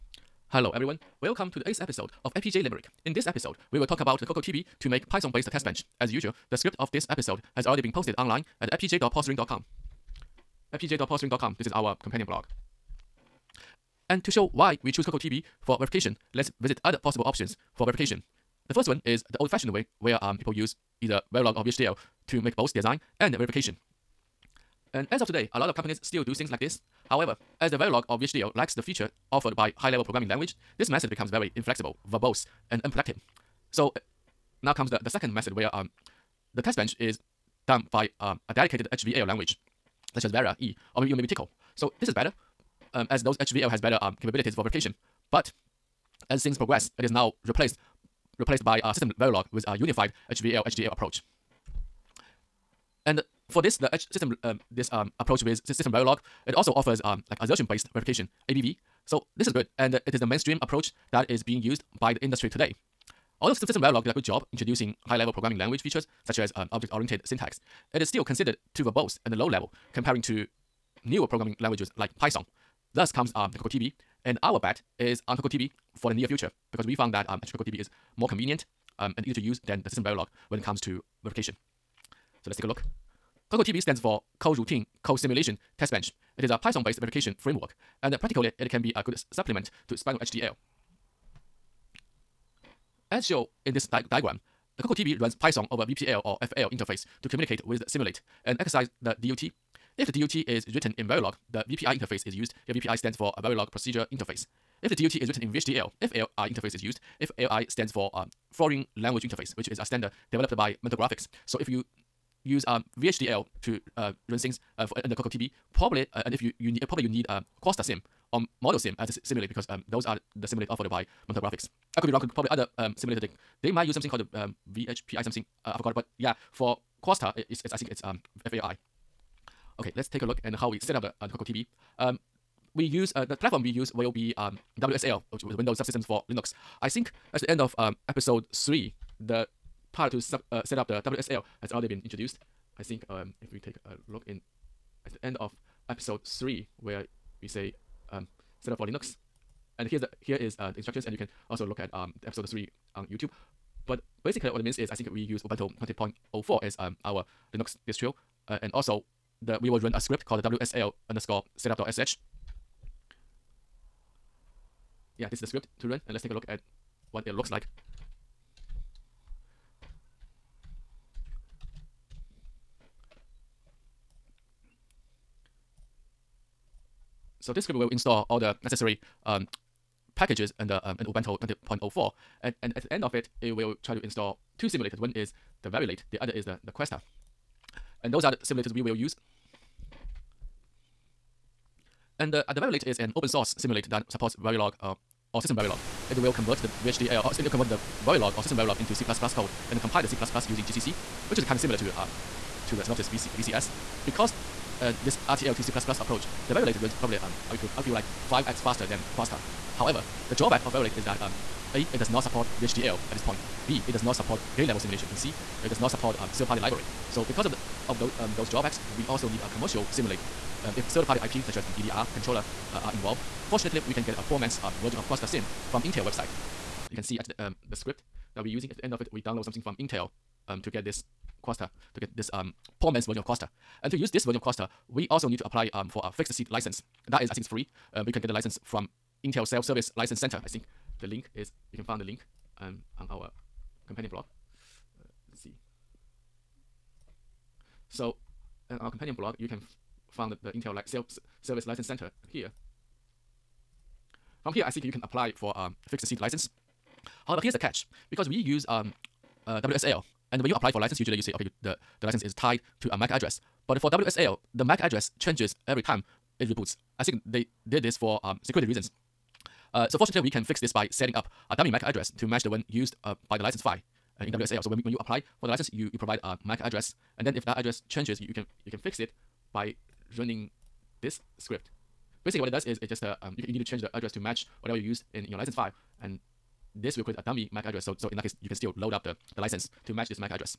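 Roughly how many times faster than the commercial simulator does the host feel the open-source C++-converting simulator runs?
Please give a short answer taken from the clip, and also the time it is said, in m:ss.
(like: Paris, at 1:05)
5x, at 3:28.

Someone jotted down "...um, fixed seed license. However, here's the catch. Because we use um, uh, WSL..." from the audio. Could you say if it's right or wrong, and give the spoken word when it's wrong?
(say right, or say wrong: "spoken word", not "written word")
right.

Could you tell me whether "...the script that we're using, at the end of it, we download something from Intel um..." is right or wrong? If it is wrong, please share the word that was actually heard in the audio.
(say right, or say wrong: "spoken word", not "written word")
right.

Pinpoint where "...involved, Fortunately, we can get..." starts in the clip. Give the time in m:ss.
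3:42.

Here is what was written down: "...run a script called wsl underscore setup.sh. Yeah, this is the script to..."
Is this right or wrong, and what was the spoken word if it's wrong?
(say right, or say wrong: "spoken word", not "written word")
right.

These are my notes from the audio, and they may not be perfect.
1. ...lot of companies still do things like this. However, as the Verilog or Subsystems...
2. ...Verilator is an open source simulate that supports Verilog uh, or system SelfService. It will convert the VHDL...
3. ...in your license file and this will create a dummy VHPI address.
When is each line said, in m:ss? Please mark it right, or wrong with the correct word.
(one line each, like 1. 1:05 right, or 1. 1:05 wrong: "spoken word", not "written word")
1. 0:25 wrong: "VHDL", not "Subsystems"
2. 3:12 wrong: "Verilog", not "SelfService"
3. 4:45 wrong: "MAC", not "VHPI".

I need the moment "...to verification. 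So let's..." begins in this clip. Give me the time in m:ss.
1:20.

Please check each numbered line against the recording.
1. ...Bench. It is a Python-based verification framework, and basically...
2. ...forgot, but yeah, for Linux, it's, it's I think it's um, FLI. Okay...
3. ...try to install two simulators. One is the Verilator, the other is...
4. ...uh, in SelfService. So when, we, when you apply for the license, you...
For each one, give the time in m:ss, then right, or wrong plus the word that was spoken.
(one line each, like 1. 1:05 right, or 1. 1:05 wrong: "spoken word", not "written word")
1. 1:25 wrong: "practically", not "basically"
2. 2:05 wrong: "Questa", not "Linux"
3. 3:03 right
4. 4:34 wrong: "WSL", not "SelfService".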